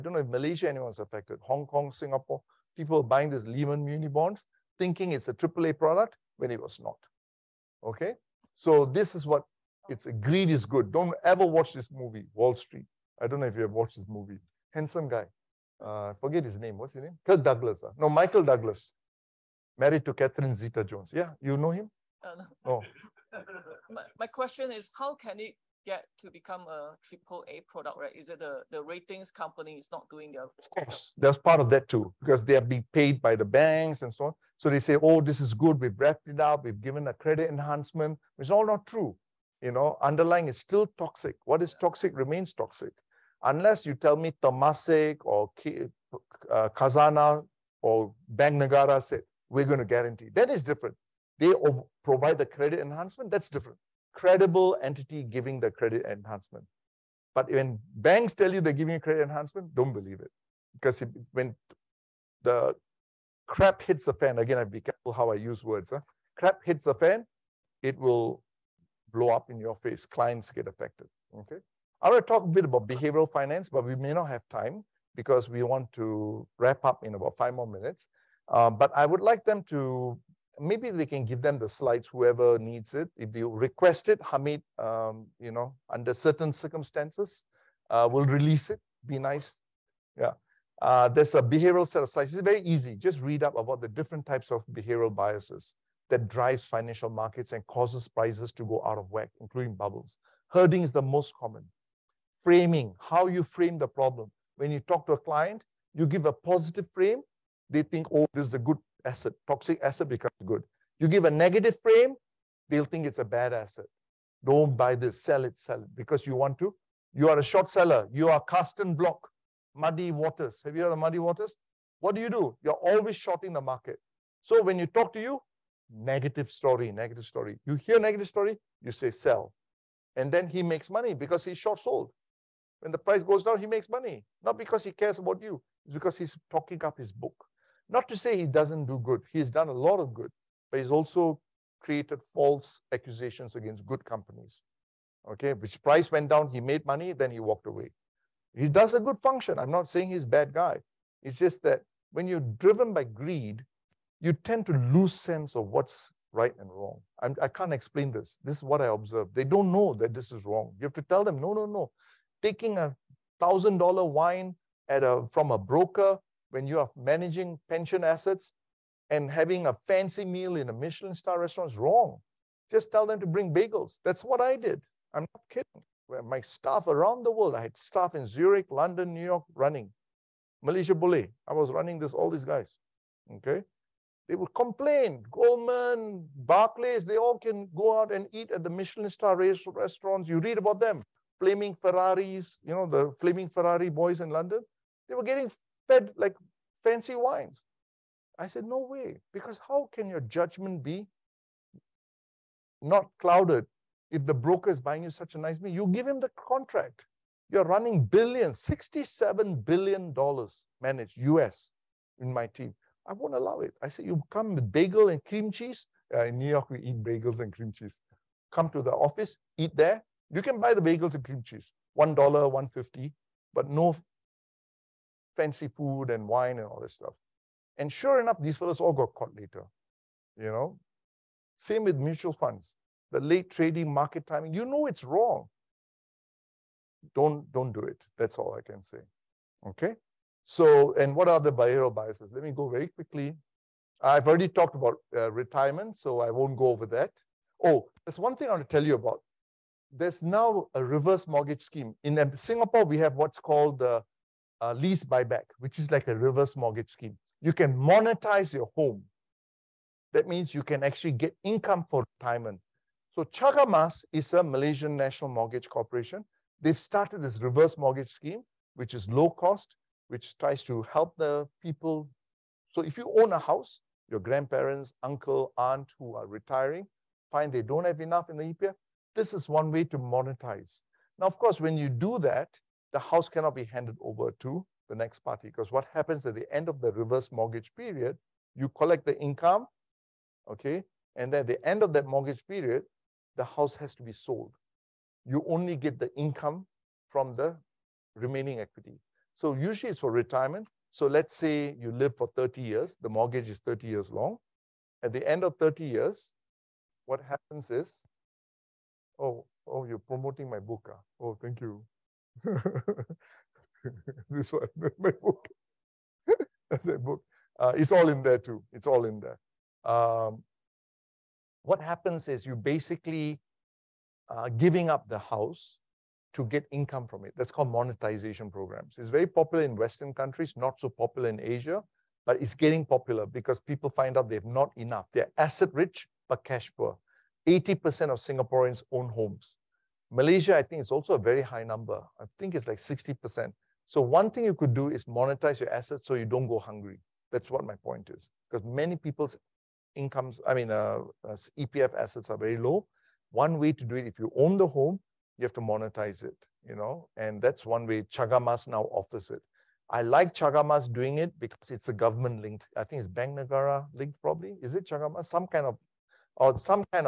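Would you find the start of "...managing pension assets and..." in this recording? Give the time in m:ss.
2:46.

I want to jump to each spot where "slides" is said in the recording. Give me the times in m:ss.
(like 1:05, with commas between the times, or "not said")
1:21, 1:32.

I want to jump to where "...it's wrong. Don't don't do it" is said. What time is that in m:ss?
3:54.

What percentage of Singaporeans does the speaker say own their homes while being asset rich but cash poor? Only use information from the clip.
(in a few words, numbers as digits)
80%.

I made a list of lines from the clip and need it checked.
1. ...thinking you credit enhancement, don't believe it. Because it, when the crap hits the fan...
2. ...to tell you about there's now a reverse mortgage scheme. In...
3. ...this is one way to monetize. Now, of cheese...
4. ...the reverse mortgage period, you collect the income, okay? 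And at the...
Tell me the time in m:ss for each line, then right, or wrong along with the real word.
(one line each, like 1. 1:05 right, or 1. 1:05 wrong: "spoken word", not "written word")
1. 0:58 wrong: "giving", not "thinking"
2. 4:08 right
3. 4:39 wrong: "course", not "cheese"
4. 4:46 right.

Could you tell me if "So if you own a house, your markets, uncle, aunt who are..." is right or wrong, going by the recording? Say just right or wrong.
wrong.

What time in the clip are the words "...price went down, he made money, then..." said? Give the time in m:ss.
2:25.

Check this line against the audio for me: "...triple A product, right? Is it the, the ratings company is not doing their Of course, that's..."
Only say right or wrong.
right.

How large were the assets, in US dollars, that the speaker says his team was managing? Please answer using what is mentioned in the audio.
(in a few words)
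$67 billion.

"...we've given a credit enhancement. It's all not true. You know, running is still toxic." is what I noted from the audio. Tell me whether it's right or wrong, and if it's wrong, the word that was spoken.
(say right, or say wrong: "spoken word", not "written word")
wrong: "underlying", not "running".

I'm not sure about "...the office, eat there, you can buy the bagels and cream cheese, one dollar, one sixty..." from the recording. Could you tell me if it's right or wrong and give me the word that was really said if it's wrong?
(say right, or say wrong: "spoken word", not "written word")
wrong: "fifty", not "sixty".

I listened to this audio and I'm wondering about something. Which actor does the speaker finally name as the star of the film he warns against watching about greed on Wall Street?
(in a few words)
Michael Douglas.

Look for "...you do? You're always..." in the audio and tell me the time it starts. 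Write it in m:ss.
2:02.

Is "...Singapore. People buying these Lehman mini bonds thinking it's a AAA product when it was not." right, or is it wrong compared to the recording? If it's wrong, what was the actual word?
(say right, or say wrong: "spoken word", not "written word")
right.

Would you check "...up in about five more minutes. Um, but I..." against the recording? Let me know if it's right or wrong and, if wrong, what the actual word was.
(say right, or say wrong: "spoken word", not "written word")
right.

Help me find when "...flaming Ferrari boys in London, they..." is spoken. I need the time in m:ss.
3:13.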